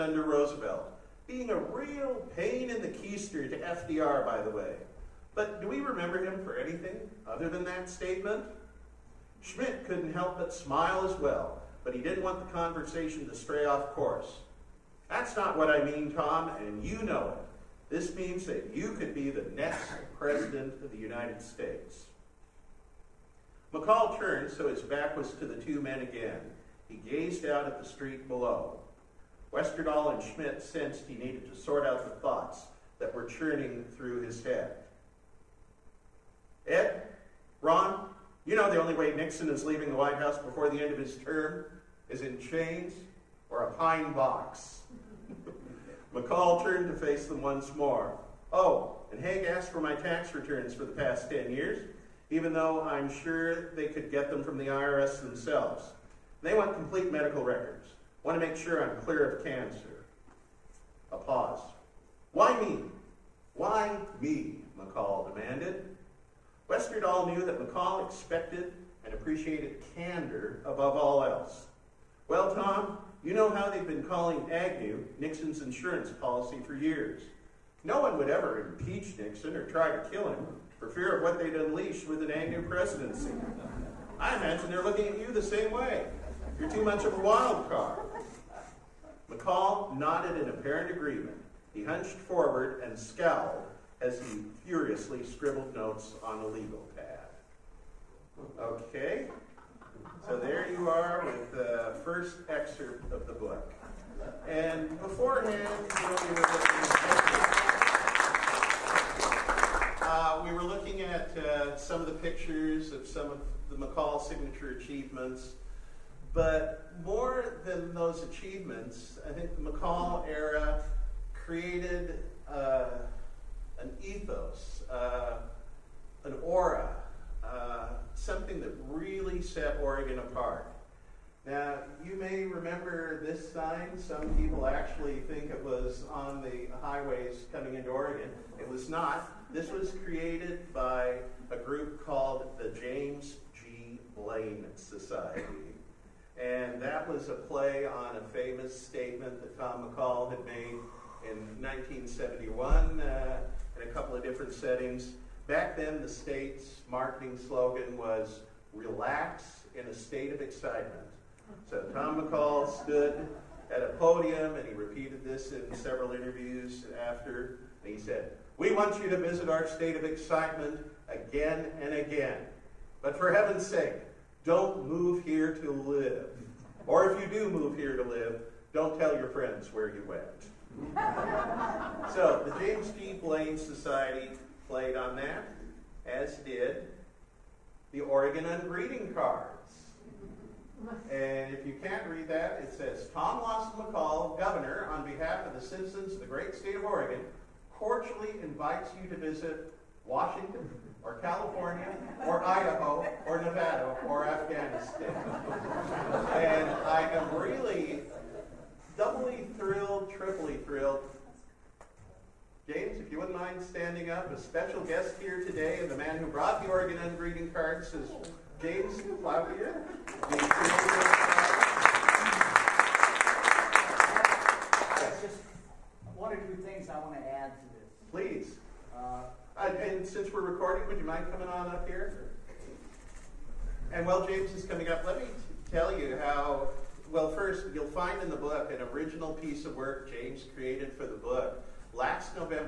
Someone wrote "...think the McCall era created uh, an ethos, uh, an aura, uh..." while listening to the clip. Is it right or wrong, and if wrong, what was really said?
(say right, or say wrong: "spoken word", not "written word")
right.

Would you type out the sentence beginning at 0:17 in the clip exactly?
This means that you could be the next president of the United States.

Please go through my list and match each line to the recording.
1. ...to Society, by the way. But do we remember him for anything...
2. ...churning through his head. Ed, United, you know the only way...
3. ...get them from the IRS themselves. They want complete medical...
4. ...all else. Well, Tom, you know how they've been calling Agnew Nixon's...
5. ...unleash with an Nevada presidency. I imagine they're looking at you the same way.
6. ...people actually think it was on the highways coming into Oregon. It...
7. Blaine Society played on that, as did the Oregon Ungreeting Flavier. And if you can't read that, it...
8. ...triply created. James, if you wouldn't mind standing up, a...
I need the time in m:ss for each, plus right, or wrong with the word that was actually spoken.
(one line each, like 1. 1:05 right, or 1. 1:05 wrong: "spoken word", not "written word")
1. 0:03 wrong: "FDR", not "Society"
2. 0:33 wrong: "Ron", not "United"
3. 0:54 right
4. 1:10 right
5. 1:21 wrong: "Agnew", not "Nevada"
6. 2:14 right
7. 3:03 wrong: "Cards", not "Flavier"
8. 3:30 wrong: "thrilled", not "created".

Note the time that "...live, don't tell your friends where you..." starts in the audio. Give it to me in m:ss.
2:58.